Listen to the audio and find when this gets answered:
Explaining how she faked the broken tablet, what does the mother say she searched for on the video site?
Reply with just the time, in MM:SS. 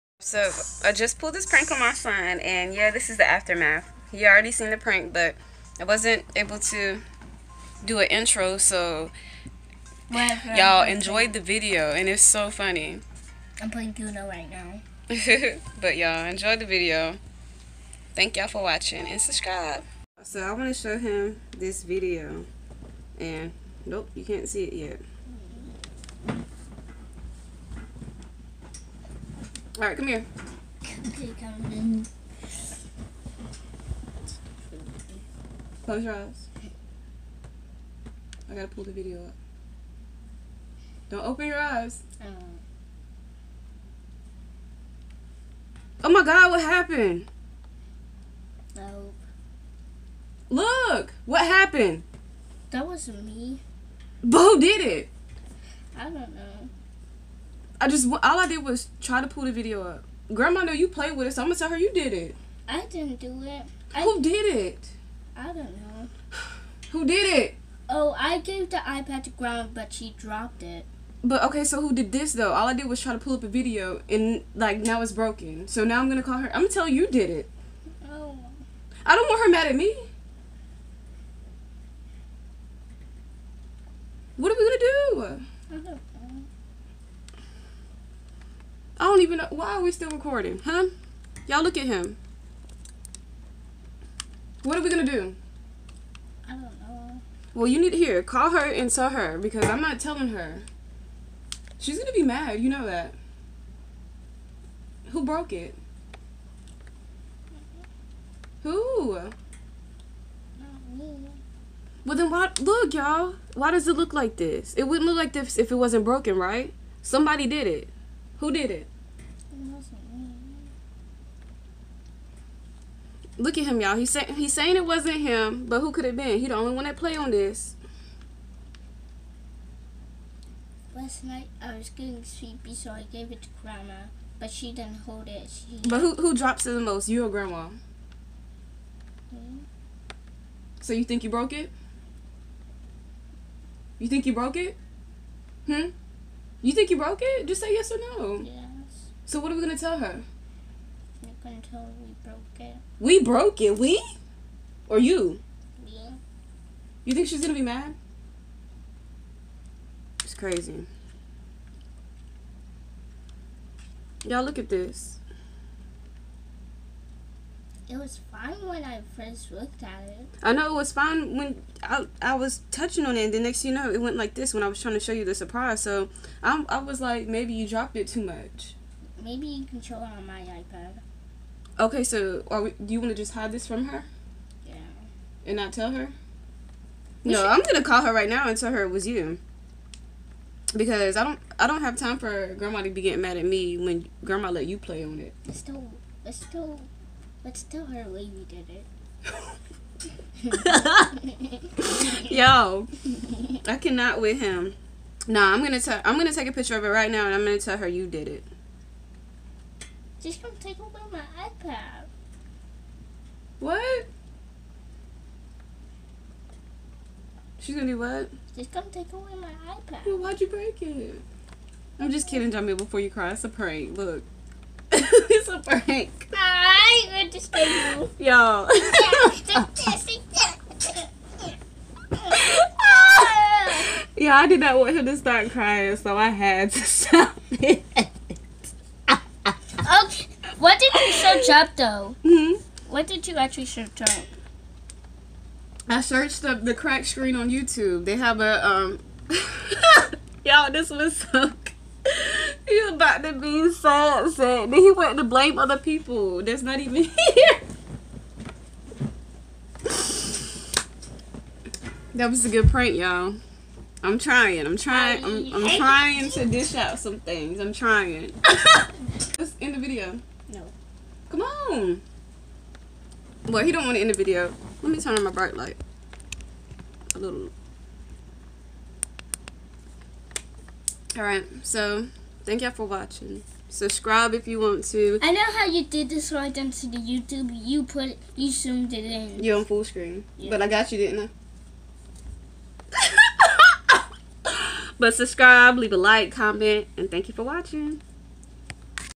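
04:06.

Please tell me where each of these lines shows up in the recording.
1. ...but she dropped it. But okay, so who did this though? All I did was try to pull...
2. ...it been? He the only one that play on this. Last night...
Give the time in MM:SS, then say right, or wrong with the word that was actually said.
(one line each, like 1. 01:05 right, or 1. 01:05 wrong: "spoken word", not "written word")
1. 01:09 right
2. 02:06 right.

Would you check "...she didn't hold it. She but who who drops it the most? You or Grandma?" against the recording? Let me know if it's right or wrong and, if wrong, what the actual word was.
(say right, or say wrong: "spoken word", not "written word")
right.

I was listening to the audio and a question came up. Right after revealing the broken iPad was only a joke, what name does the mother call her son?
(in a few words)
Jamie.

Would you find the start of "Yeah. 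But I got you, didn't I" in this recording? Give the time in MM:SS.
04:50.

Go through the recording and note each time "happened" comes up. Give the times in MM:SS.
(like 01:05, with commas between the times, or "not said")
00:46, 00:51.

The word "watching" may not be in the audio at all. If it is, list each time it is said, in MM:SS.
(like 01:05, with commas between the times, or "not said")
00:18, 04:42, 04:57.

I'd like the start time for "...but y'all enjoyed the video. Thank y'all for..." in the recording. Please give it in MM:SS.
00:15.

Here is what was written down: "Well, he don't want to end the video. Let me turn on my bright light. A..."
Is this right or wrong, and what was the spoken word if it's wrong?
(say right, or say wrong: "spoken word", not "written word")
right.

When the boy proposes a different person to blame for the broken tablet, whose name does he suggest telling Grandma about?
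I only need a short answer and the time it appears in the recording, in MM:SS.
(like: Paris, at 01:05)
Wavy, at 03:18.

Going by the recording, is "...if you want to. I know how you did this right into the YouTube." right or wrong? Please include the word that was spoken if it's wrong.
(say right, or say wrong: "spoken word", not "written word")
right.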